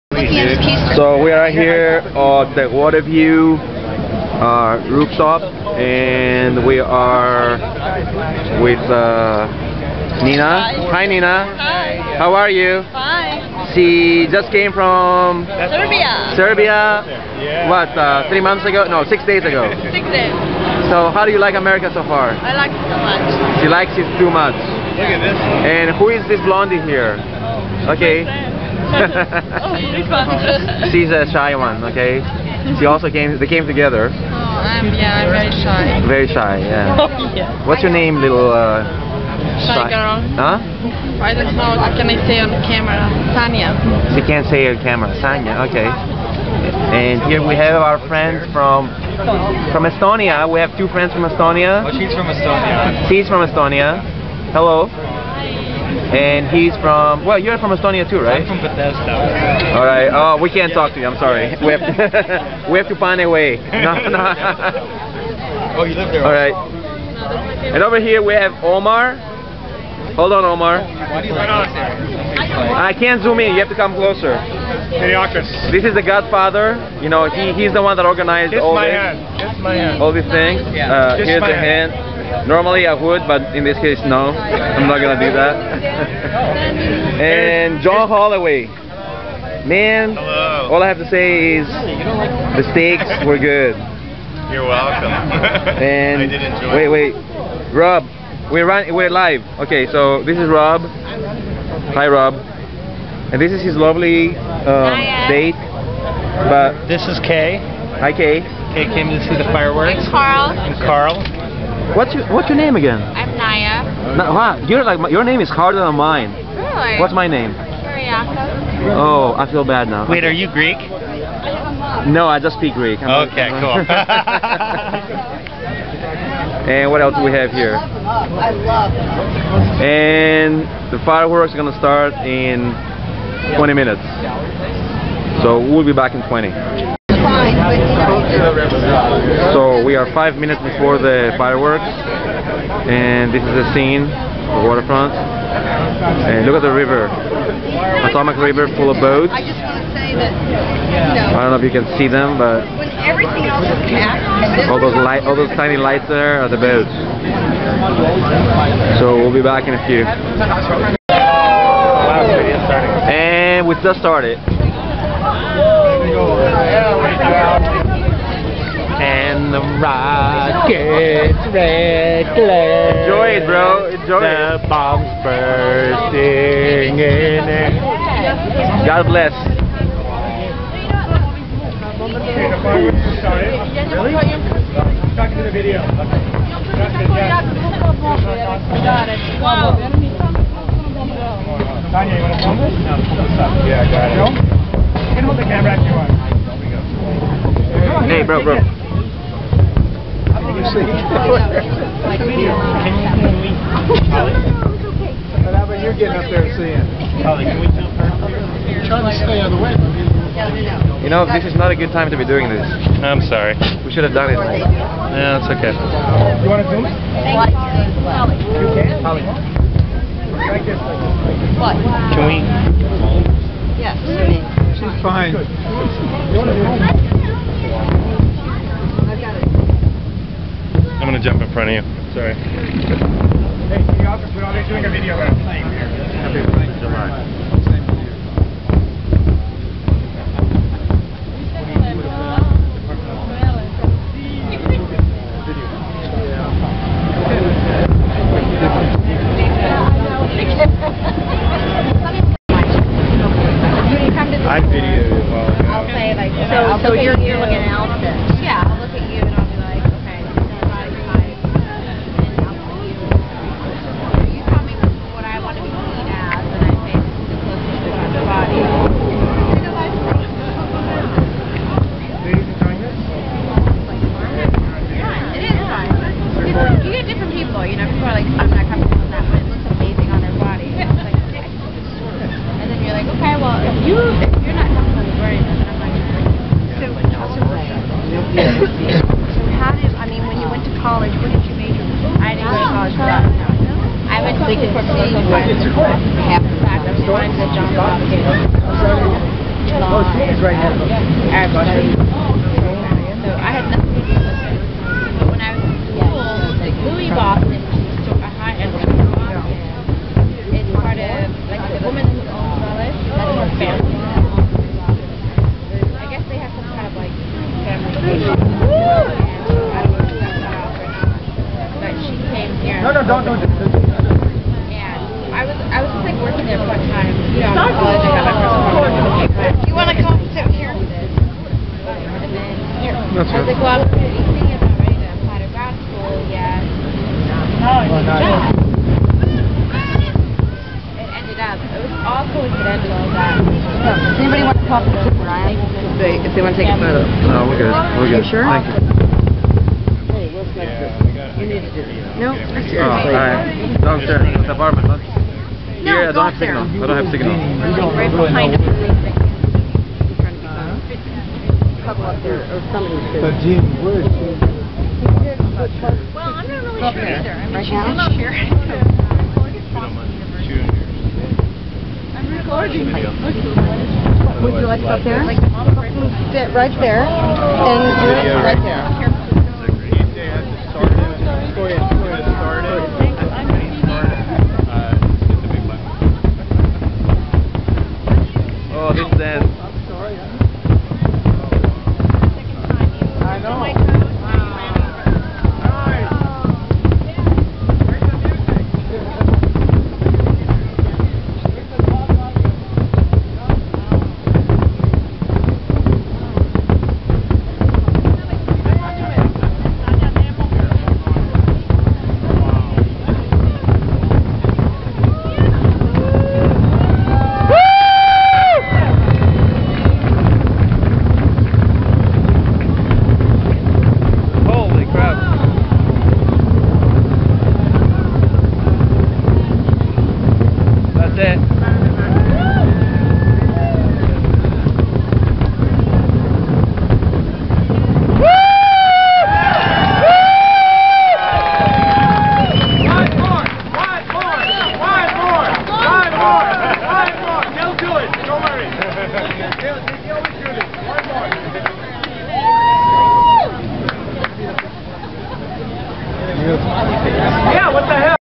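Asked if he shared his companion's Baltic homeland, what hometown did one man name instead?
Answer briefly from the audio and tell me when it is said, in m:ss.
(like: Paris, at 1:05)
Bethesda, at 0:58.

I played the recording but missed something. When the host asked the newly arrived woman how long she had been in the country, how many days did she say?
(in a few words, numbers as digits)
6.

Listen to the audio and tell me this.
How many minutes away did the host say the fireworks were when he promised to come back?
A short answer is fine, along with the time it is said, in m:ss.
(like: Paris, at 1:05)
20, at 2:13.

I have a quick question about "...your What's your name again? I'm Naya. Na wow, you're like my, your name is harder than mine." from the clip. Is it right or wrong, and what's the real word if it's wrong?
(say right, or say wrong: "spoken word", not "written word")
right.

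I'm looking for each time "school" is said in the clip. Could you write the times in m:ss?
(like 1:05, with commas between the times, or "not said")
5:05, 5:33.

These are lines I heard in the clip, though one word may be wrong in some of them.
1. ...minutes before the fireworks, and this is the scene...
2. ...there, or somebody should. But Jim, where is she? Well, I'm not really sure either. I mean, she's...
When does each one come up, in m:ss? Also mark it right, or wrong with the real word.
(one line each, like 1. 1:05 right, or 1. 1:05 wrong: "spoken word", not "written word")
1. 2:20 right
2. 6:02 right.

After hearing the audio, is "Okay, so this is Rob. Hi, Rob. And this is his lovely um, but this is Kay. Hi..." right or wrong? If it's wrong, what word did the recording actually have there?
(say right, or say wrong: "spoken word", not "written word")
right.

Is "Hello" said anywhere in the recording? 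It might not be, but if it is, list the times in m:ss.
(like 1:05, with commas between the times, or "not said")
0:54, 1:30.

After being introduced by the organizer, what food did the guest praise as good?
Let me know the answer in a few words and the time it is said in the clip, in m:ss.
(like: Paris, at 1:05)
steaks, at 1:32.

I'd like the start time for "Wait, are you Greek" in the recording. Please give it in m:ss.
2:00.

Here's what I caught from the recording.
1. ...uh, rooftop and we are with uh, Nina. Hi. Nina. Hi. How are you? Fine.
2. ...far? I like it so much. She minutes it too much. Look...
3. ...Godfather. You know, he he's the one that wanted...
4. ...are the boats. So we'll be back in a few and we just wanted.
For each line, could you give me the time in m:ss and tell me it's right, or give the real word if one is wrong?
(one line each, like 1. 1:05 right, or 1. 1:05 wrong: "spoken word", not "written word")
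1. 0:04 right
2. 0:22 wrong: "likes", not "minutes"
3. 1:16 wrong: "organized", not "wanted"
4. 2:36 wrong: "started", not "wanted".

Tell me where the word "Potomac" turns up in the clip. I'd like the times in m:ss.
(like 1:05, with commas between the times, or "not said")
2:28.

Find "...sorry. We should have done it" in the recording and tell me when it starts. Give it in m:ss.
3:33.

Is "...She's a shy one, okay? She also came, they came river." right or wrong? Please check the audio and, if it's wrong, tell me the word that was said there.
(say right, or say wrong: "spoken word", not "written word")
wrong: "together", not "river".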